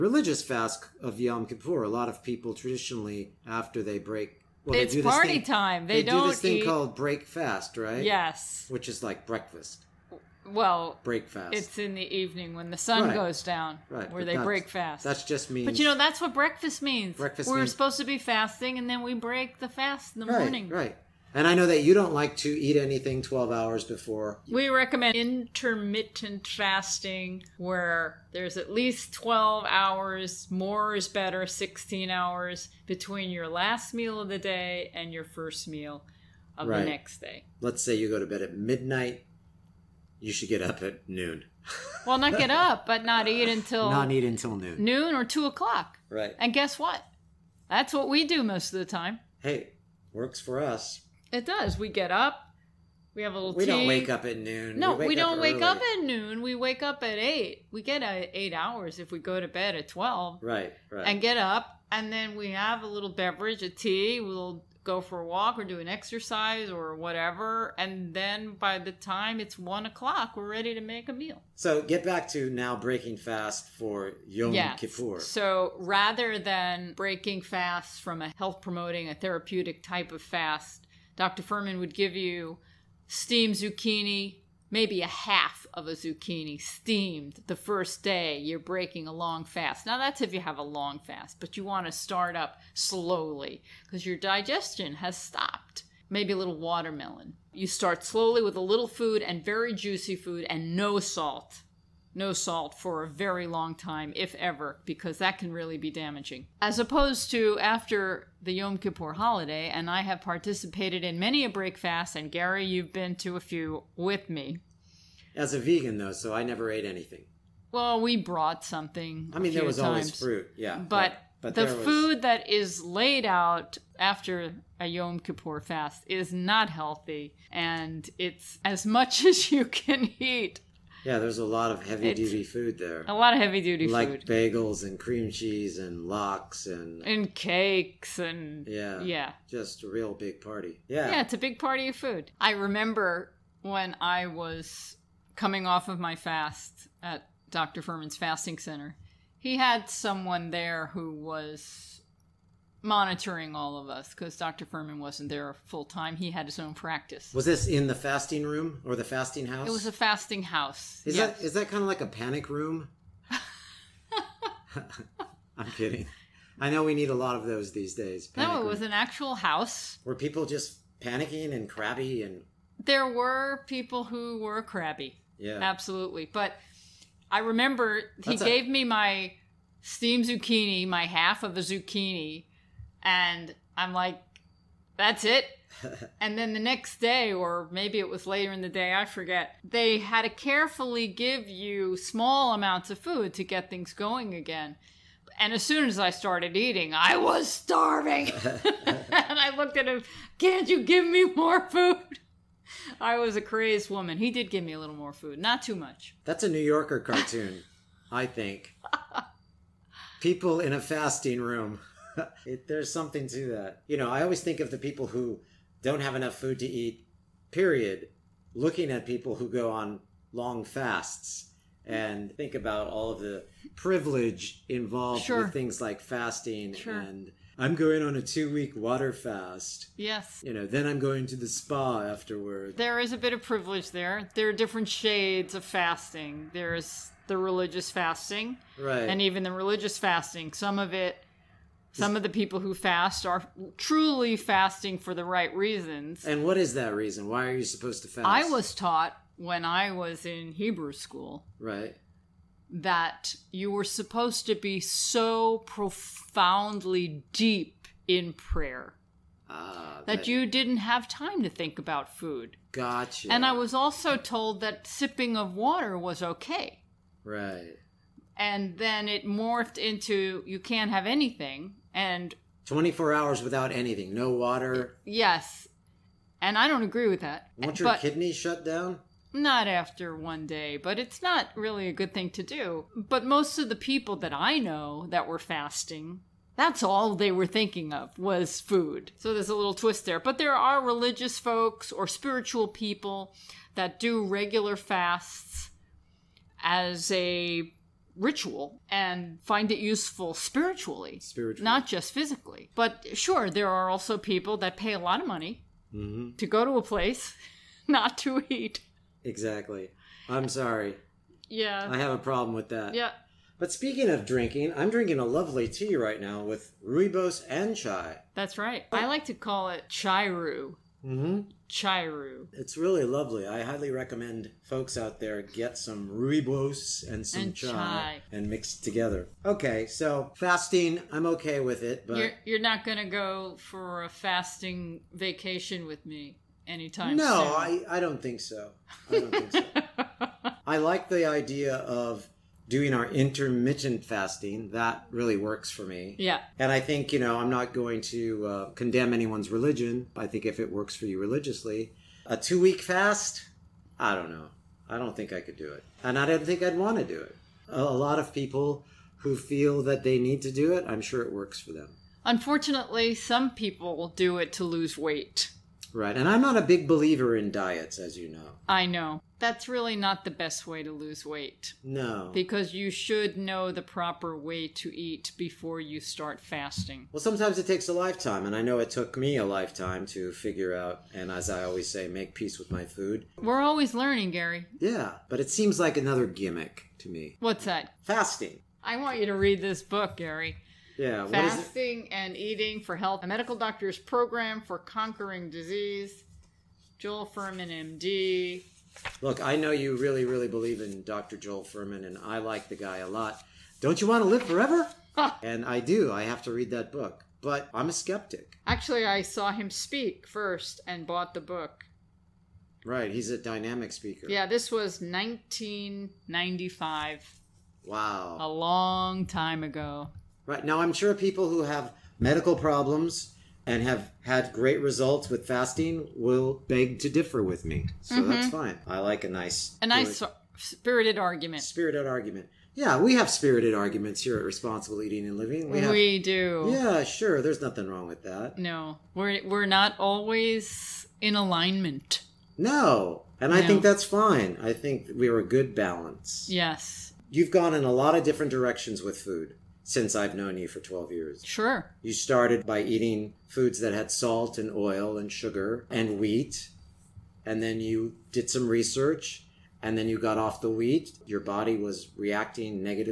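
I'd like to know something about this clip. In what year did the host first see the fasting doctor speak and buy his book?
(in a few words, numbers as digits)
1995.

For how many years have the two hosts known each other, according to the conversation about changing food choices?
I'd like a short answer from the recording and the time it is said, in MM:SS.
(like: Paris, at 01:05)
12, at 07:30.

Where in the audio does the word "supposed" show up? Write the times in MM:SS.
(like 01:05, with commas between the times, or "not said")
00:17, 04:07, 04:13.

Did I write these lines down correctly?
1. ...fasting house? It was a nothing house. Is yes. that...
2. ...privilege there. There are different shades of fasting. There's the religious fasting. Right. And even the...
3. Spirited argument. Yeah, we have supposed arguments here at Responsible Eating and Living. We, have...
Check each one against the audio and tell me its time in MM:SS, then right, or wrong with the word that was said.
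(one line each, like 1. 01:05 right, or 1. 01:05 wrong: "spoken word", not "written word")
1. 02:39 wrong: "fasting", not "nothing"
2. 03:53 right
3. 07:11 wrong: "spirited", not "supposed".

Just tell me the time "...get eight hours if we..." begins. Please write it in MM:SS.
00:57.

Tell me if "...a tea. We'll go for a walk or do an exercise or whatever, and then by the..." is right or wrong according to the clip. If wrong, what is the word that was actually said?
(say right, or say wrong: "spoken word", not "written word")
right.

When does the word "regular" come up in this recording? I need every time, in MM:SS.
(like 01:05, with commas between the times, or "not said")
04:54.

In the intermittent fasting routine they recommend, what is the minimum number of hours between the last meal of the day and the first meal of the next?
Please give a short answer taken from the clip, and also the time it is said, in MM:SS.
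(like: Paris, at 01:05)
12, at 00:28.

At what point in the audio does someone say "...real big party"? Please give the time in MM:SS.
02:19.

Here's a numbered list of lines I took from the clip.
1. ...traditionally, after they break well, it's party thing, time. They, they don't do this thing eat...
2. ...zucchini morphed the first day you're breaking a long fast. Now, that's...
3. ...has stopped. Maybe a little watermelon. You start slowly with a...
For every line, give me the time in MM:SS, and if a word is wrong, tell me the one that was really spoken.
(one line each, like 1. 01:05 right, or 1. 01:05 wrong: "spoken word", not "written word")
1. 00:02 right
2. 01:25 wrong: "steamed", not "morphed"
3. 01:34 right.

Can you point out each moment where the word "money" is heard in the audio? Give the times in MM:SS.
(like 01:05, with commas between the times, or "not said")
05:05.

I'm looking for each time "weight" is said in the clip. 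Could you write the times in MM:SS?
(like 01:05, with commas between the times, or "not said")
06:04, 06:11.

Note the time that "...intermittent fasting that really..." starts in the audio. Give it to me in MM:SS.
05:43.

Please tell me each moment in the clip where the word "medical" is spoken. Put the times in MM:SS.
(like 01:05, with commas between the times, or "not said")
06:33, 07:02.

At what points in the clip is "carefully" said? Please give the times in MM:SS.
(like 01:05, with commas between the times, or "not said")
03:10.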